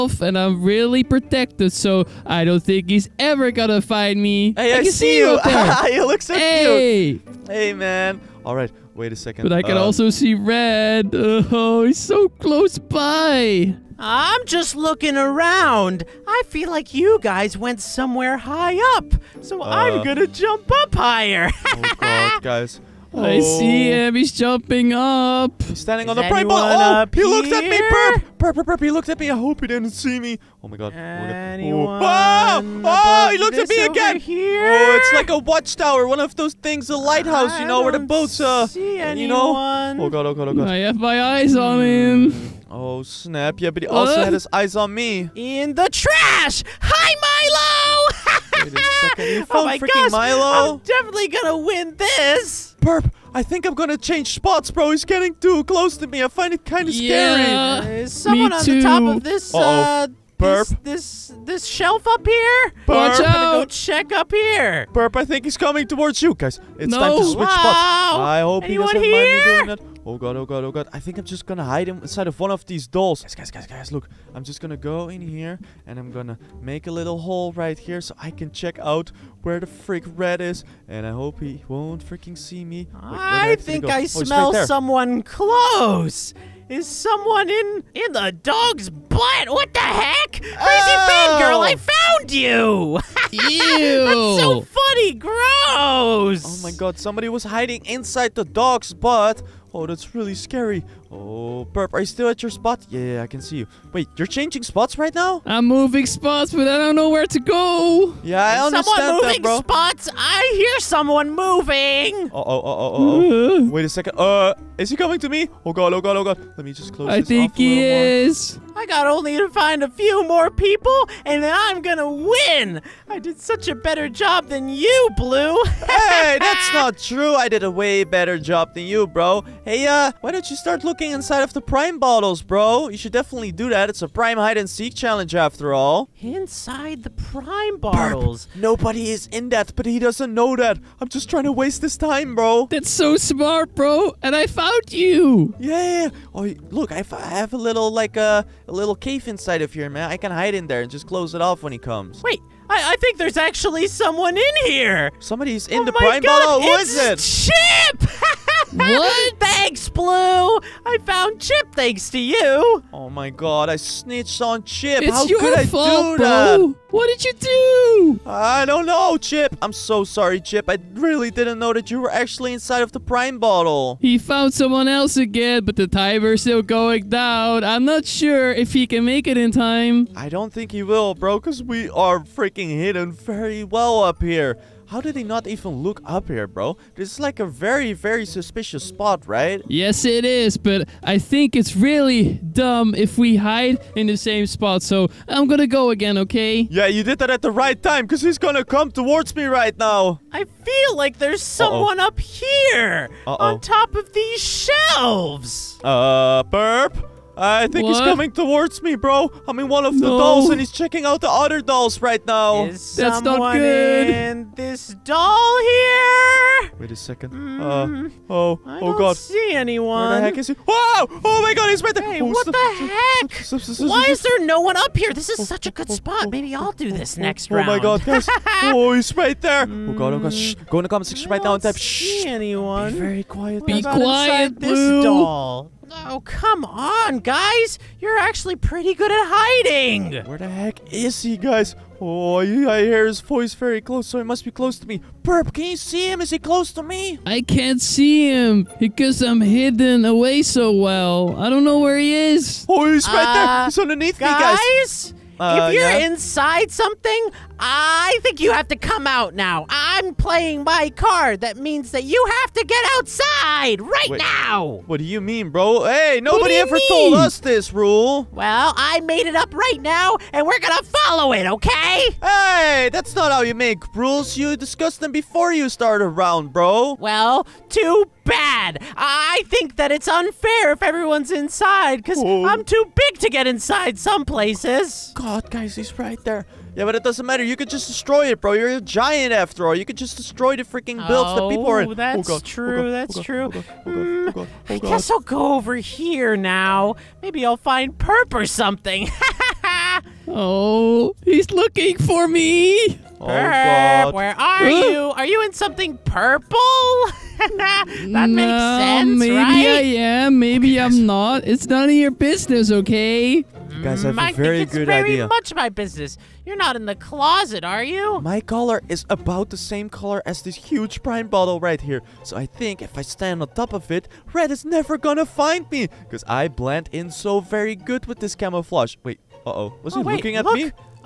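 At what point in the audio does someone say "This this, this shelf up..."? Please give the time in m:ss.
1:00.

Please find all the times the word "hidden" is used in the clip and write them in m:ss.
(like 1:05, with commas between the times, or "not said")
3:02, 4:09.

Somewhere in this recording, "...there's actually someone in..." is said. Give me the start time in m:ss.
2:33.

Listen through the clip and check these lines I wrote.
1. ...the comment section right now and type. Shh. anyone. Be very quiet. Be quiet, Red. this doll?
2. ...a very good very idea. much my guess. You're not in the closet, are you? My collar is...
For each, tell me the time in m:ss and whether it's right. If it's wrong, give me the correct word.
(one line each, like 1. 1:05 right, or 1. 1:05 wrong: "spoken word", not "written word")
1. 3:50 wrong: "Blue", not "Red"
2. 5:14 wrong: "business", not "guess".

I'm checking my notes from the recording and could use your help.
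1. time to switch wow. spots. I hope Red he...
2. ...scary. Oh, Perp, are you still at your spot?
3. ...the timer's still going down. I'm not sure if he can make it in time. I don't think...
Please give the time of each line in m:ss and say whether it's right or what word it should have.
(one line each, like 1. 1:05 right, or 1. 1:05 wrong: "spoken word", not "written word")
1. 1:06 wrong: "Anyone", not "Red"
2. 1:40 right
3. 2:55 right.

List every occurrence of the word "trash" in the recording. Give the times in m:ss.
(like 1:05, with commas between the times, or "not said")
0:45.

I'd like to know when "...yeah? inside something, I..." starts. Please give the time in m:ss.
4:15.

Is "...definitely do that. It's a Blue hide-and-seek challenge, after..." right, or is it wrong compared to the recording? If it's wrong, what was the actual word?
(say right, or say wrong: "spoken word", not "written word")
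wrong: "Prime", not "Blue".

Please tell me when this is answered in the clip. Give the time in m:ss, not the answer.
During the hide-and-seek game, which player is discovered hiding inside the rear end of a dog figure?
1:31.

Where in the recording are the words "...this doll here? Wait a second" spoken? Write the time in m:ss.
3:34.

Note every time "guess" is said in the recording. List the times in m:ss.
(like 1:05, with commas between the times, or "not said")
4:54.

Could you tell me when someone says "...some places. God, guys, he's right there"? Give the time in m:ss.
4:43.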